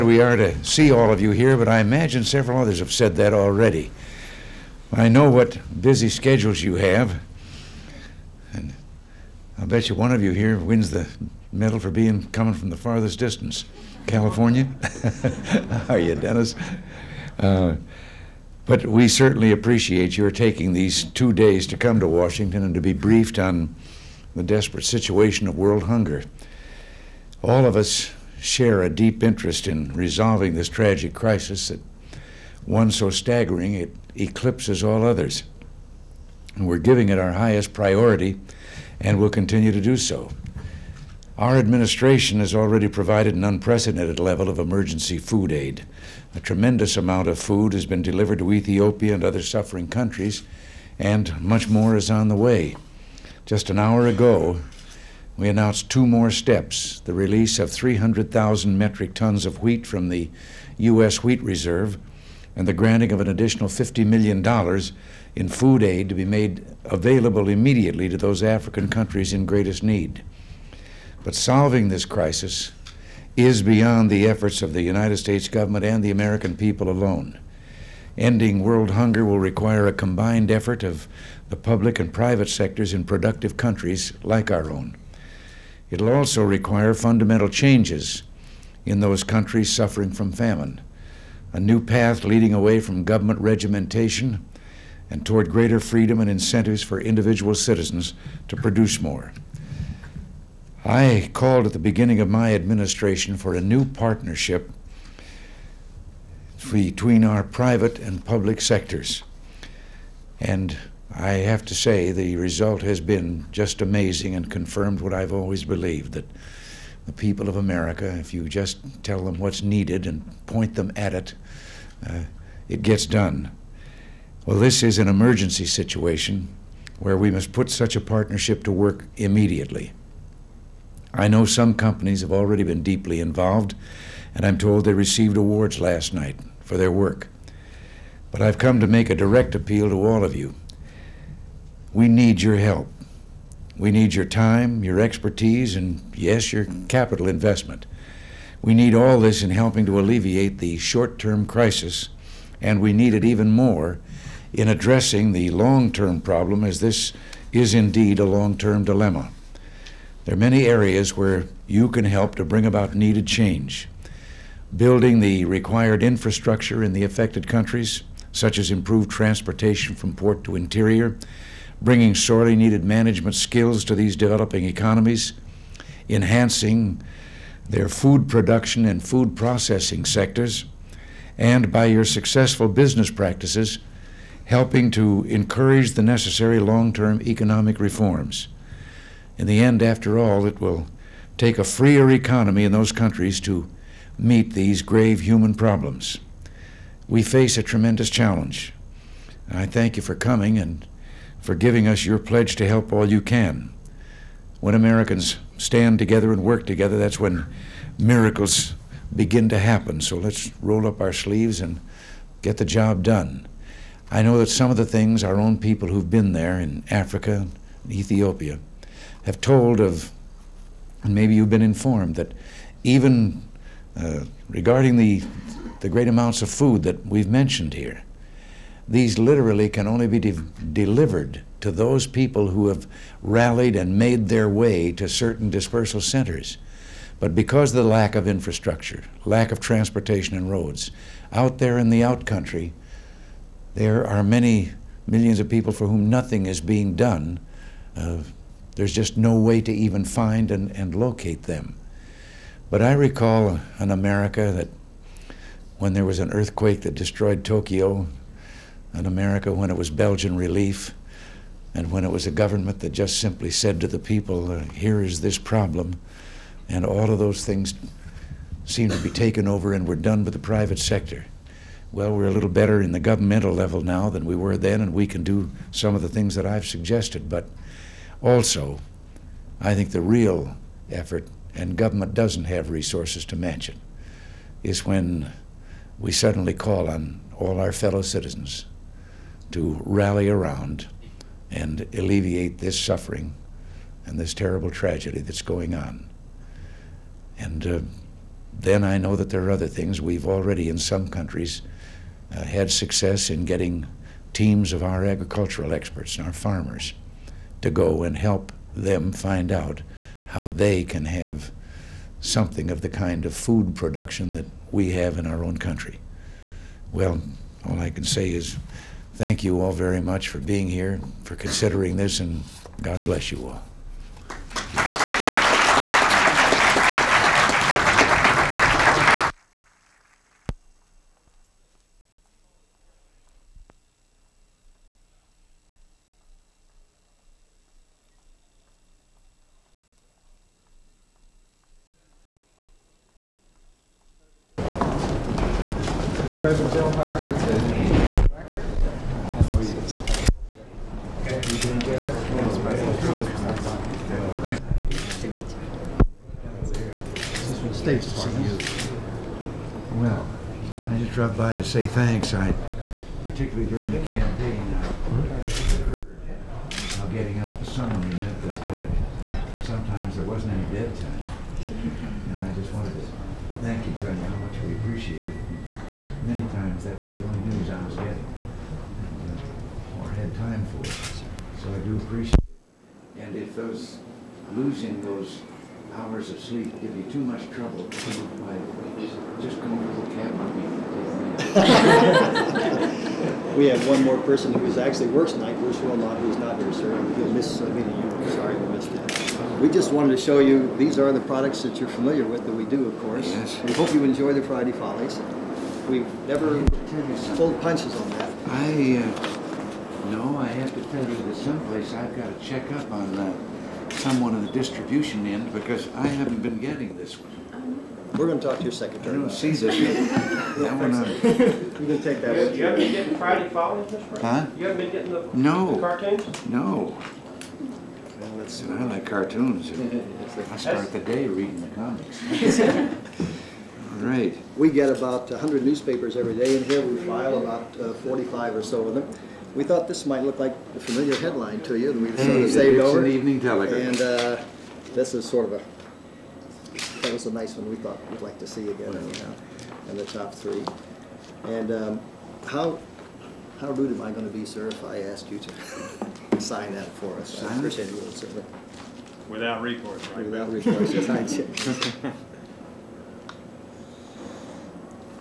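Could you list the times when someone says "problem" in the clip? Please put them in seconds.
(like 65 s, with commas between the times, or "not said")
156 s, 195 s, 265 s.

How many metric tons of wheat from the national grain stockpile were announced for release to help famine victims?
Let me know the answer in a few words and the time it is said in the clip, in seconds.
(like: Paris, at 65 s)
300,000, at 57 s.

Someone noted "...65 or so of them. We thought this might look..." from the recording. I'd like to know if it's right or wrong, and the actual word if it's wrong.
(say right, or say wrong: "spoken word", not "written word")
wrong: "45", not "65".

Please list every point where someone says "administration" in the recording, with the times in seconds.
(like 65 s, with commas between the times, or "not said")
41 s, 102 s.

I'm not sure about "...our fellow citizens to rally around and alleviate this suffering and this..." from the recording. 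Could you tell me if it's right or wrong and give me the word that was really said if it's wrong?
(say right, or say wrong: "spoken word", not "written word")
right.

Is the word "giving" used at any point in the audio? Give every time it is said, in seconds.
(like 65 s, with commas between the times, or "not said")
36 s, 201 s.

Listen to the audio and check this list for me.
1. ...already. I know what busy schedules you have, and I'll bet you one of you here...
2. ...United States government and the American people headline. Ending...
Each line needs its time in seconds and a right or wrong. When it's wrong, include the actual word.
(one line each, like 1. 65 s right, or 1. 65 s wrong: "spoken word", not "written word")
1. 3 s right
2. 74 s wrong: "alone", not "headline".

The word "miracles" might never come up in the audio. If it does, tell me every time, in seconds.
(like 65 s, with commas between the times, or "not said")
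207 s.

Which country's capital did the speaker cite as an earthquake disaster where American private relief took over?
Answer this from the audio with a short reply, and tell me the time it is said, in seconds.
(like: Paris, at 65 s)
Tokyo, at 257 s.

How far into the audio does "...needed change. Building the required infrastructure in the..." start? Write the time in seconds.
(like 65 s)
162 s.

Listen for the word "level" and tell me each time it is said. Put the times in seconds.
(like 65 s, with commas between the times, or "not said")
44 s, 273 s.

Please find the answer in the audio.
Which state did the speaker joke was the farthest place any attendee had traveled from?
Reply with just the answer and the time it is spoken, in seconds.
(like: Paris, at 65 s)
California, at 14 s.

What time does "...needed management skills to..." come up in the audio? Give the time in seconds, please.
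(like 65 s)
172 s.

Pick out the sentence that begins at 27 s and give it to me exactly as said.
All of us share a deep interest in resolving this tragic crisis that one so staggering it eclipses all others.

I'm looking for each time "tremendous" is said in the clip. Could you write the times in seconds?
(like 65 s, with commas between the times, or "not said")
46 s, 197 s.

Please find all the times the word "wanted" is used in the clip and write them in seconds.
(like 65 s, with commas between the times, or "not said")
372 s, 399 s.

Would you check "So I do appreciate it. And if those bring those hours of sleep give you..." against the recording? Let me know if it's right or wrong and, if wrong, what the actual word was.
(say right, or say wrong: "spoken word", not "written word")
wrong: "losing", not "bring".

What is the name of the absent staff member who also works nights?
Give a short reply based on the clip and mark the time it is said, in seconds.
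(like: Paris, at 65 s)
Bruce Wilmot, at 395 s.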